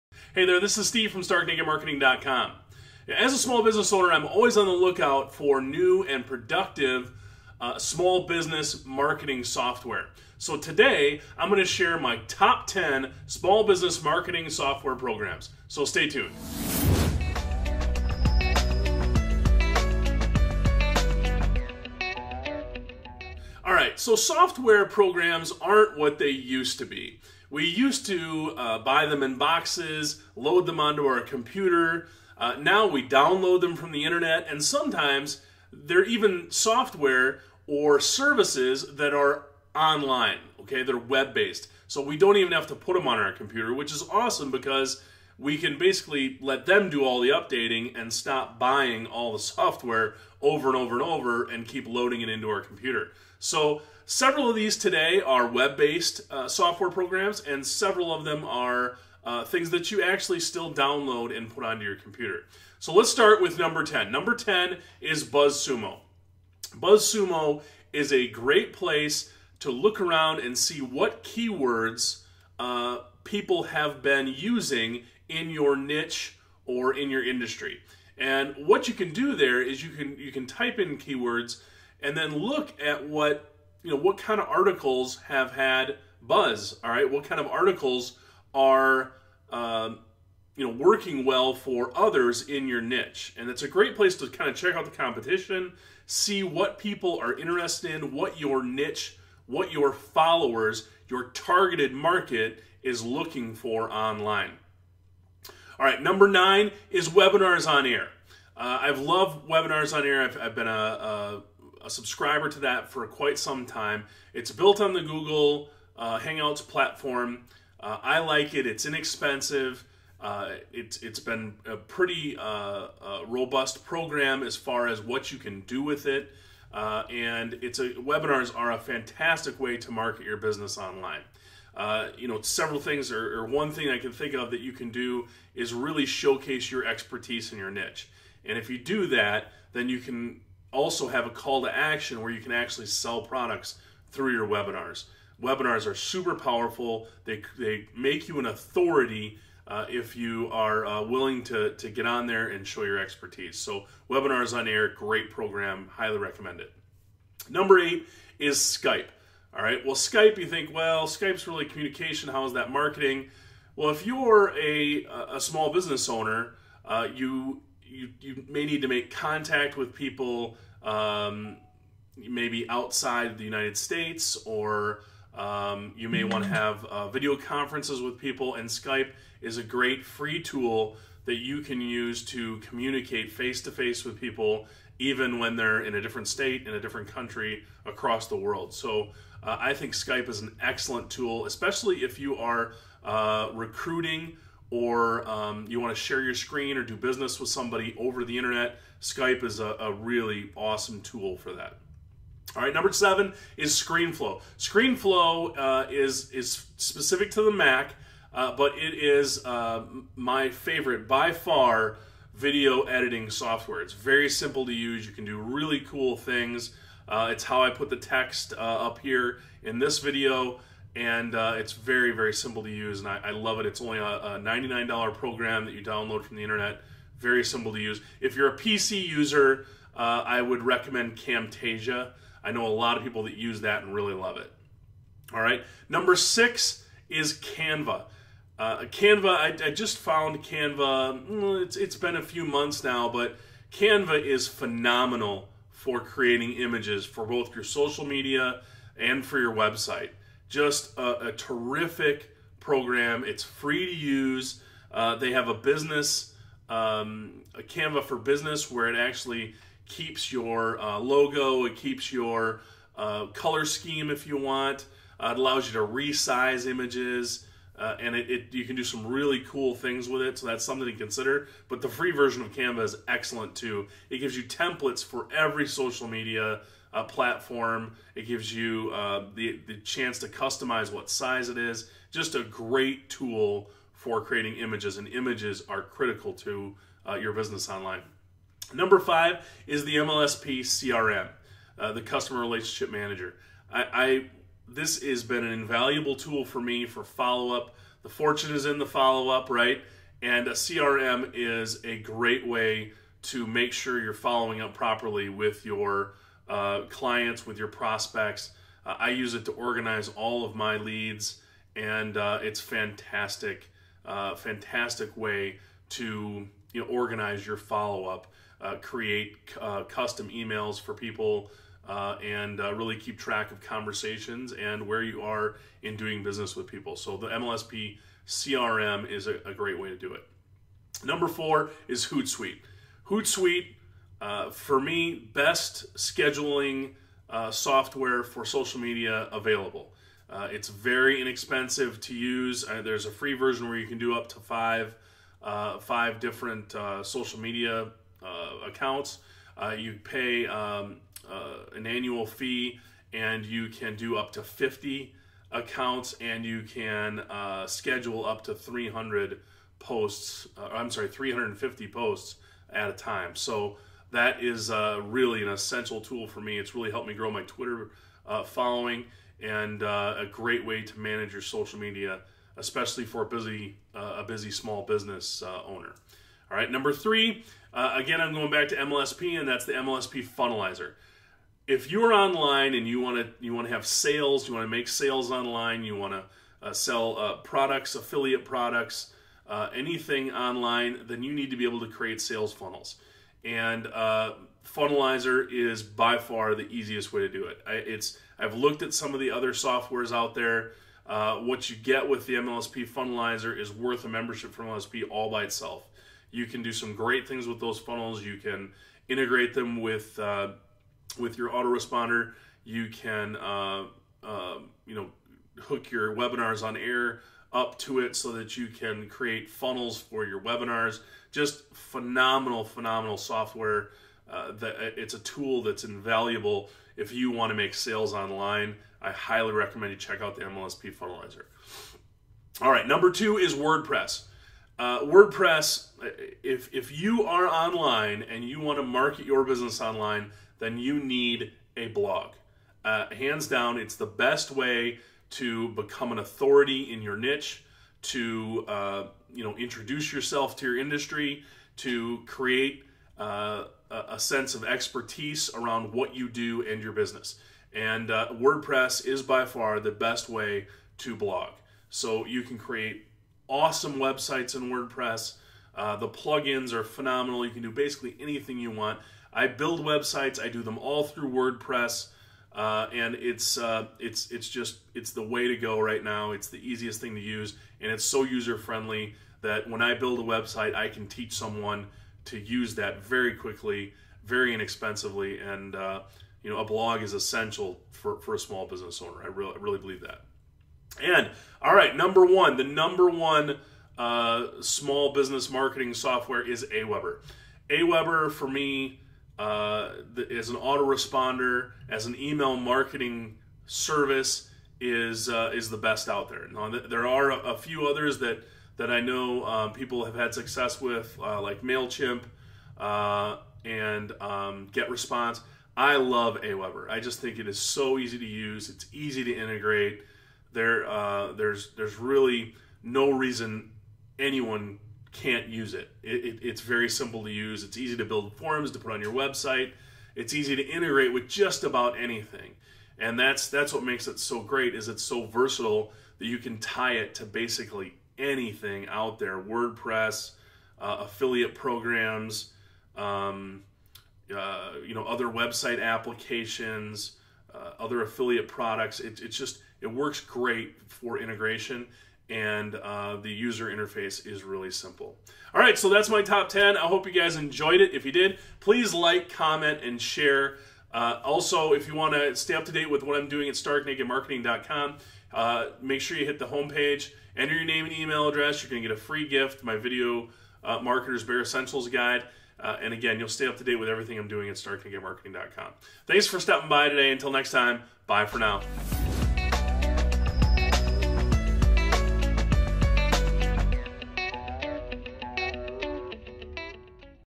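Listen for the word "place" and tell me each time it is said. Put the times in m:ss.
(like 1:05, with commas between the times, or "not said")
1:08, 1:33.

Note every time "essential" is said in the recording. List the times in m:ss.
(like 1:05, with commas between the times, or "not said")
6:05, 8:07, 9:31.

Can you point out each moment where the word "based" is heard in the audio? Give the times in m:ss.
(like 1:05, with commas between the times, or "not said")
0:41, 0:55.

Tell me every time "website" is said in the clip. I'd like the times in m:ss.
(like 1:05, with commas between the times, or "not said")
4:09, 7:43, 7:49, 8:00, 8:49, 9:05.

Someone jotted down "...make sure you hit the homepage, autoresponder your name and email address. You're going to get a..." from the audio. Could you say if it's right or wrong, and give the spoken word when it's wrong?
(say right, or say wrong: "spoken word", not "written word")
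wrong: "enter", not "autoresponder".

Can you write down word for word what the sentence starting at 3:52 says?
I know a lot of people that use that and really love it.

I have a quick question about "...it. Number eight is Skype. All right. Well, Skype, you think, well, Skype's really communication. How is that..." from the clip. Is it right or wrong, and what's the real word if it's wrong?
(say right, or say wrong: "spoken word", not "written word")
right.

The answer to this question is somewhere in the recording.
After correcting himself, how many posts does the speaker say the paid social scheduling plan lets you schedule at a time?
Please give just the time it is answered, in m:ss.
6:01.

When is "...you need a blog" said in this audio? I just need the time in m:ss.
7:20.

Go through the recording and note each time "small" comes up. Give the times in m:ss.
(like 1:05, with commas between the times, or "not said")
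0:03, 0:07, 0:13, 2:45, 6:14, 8:08, 8:14.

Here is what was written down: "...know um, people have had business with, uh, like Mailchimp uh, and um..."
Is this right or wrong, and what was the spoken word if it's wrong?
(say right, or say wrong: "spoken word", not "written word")
wrong: "success", not "business".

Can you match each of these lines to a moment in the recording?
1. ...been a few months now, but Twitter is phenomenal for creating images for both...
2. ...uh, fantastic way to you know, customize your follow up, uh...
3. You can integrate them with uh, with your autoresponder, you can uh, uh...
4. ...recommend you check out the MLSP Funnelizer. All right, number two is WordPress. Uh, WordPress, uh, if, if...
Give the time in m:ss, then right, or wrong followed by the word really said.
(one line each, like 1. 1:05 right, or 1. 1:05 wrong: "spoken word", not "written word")
1. 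4:01 wrong: "Canva", not "Twitter"
2. 5:14 wrong: "organize", not "customize"
3. 6:48 right
4. 7:09 right.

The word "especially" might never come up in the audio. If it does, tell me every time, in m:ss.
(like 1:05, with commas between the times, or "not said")
3:11, 6:12.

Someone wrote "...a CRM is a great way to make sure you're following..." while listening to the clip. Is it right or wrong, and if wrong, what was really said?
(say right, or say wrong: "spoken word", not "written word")
right.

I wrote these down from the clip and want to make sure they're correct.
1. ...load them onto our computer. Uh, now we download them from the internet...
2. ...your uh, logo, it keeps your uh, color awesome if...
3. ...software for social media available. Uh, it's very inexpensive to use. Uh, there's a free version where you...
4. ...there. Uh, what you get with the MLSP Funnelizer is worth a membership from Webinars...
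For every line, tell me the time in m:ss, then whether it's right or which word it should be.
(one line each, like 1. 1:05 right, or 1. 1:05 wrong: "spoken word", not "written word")
1. 0:30 right
2. 4:20 wrong: "scheme", not "awesome"
3. 5:37 right
4. 6:40 wrong: "MLSP", not "Webinars".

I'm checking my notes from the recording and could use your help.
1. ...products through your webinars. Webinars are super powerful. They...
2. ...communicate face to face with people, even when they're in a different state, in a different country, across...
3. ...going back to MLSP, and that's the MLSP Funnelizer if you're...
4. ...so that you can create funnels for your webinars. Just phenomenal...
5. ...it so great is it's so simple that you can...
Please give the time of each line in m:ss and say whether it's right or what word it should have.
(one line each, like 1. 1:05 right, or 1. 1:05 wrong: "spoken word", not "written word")
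1. 2:23 right
2. 3:02 right
3. 6:18 right
4. 6:58 right
5. 8:54 wrong: "versatile", not "simple".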